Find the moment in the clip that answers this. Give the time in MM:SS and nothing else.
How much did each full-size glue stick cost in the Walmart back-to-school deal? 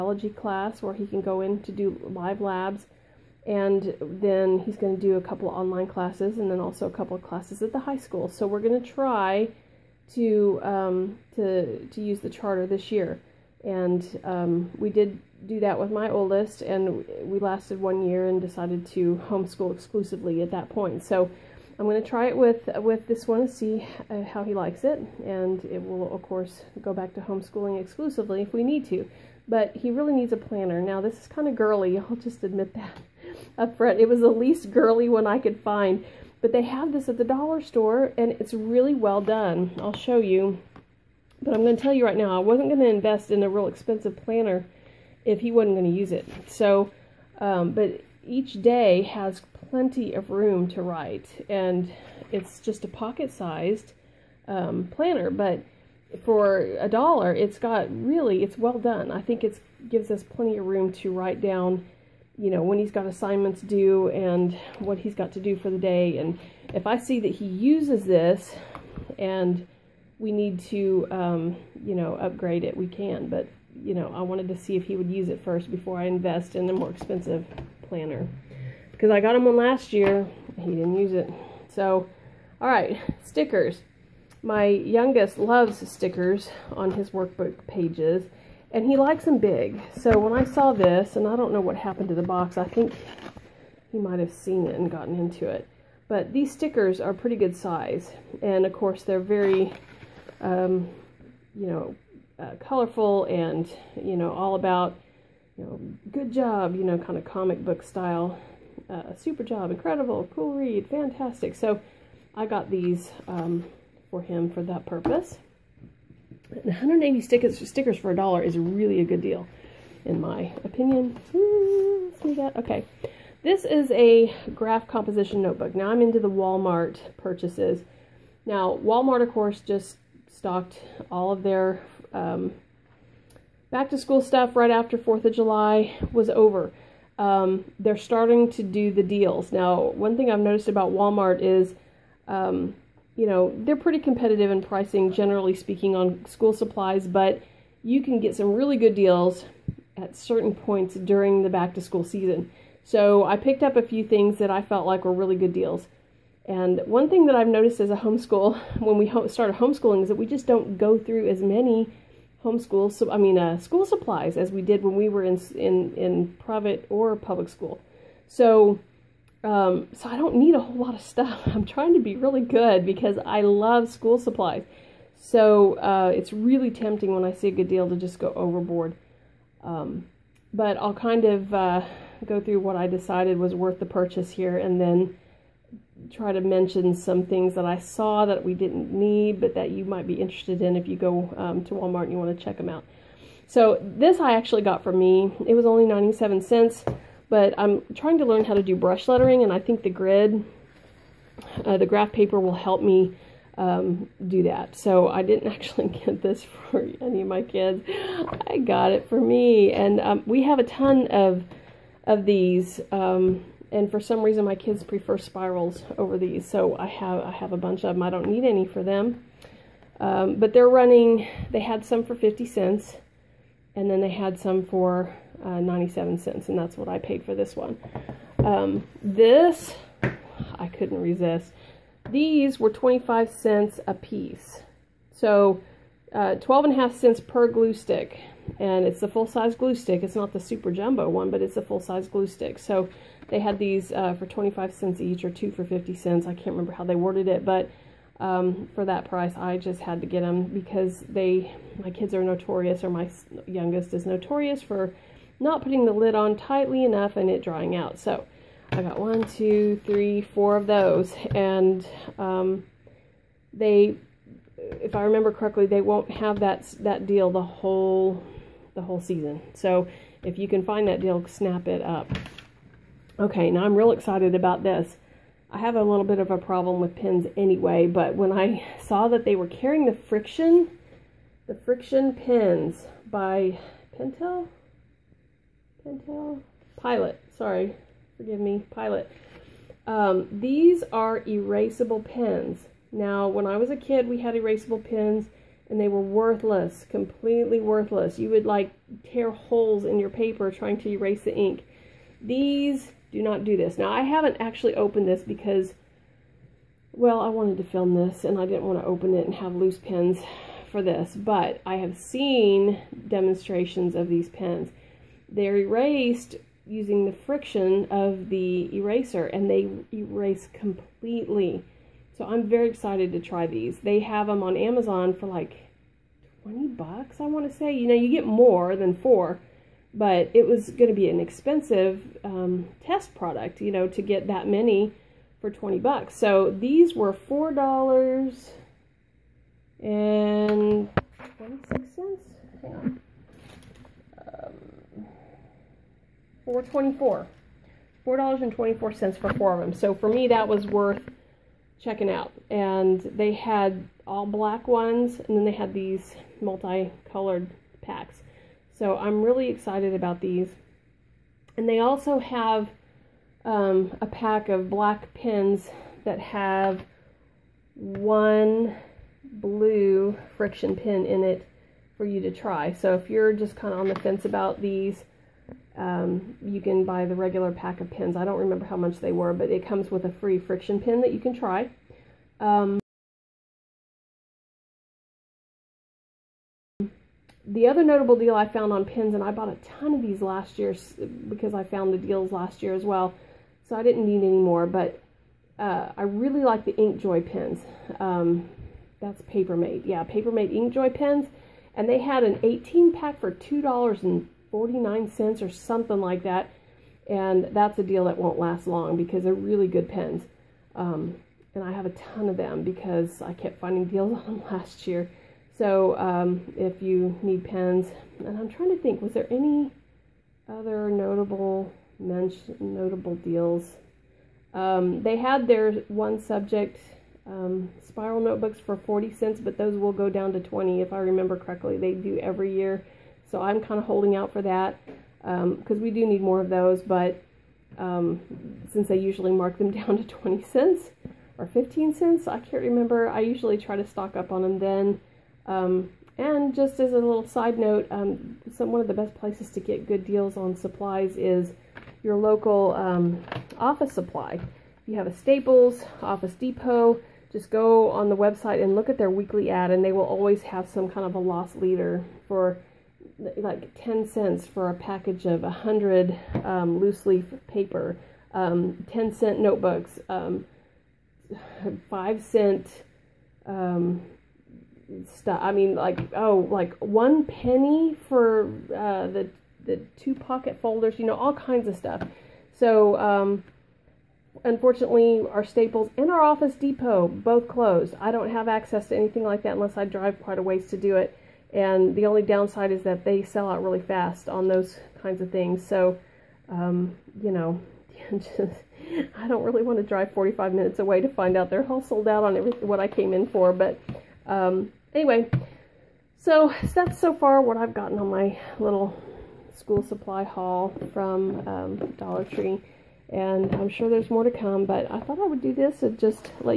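03:52.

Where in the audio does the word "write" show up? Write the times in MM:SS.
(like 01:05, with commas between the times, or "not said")
00:50, 01:01.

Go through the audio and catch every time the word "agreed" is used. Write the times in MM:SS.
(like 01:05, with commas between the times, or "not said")
not said.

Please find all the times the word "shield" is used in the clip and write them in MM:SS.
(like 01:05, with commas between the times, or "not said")
not said.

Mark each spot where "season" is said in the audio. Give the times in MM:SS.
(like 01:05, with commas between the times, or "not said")
02:32, 04:29.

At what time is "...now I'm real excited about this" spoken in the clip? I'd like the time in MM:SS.
04:33.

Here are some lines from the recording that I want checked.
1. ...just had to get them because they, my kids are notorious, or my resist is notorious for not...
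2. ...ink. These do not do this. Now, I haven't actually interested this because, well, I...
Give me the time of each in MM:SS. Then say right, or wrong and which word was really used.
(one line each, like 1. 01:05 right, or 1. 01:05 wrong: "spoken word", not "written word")
1. 04:09 wrong: "youngest", not "resist"
2. 05:01 wrong: "opened", not "interested".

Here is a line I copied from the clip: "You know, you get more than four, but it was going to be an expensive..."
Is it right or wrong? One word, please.
right.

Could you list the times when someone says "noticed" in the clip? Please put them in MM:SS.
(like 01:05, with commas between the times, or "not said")
02:20, 02:37.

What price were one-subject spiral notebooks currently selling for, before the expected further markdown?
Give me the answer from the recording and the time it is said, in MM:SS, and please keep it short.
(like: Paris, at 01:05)
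40 cents, at 07:08.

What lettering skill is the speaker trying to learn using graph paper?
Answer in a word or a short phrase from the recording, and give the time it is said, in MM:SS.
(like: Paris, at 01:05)
brush lettering, at 03:18.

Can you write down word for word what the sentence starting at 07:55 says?
I mean, like, oh, like one penny for uh, the, the two pocket folders, you know, all kinds of stuff.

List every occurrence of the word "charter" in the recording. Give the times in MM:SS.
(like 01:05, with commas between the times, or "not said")
00:12.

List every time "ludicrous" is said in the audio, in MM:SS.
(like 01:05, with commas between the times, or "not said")
not said.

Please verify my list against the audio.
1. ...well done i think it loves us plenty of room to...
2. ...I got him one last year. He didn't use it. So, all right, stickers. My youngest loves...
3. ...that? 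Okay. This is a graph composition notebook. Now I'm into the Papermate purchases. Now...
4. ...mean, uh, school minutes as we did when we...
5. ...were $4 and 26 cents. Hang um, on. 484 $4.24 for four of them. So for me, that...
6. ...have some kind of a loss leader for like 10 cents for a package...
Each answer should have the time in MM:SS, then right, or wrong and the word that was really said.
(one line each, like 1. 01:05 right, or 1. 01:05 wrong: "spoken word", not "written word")
1. 00:58 wrong: "gives", not "loves"
2. 01:19 right
3. 02:02 wrong: "Walmart", not "Papermate"
4. 02:43 wrong: "supplies", not "minutes"
5. 05:36 wrong: "424", not "484"
6. 07:40 right.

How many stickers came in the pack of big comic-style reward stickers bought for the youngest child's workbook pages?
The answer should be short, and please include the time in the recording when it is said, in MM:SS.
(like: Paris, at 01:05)
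180, at 01:56.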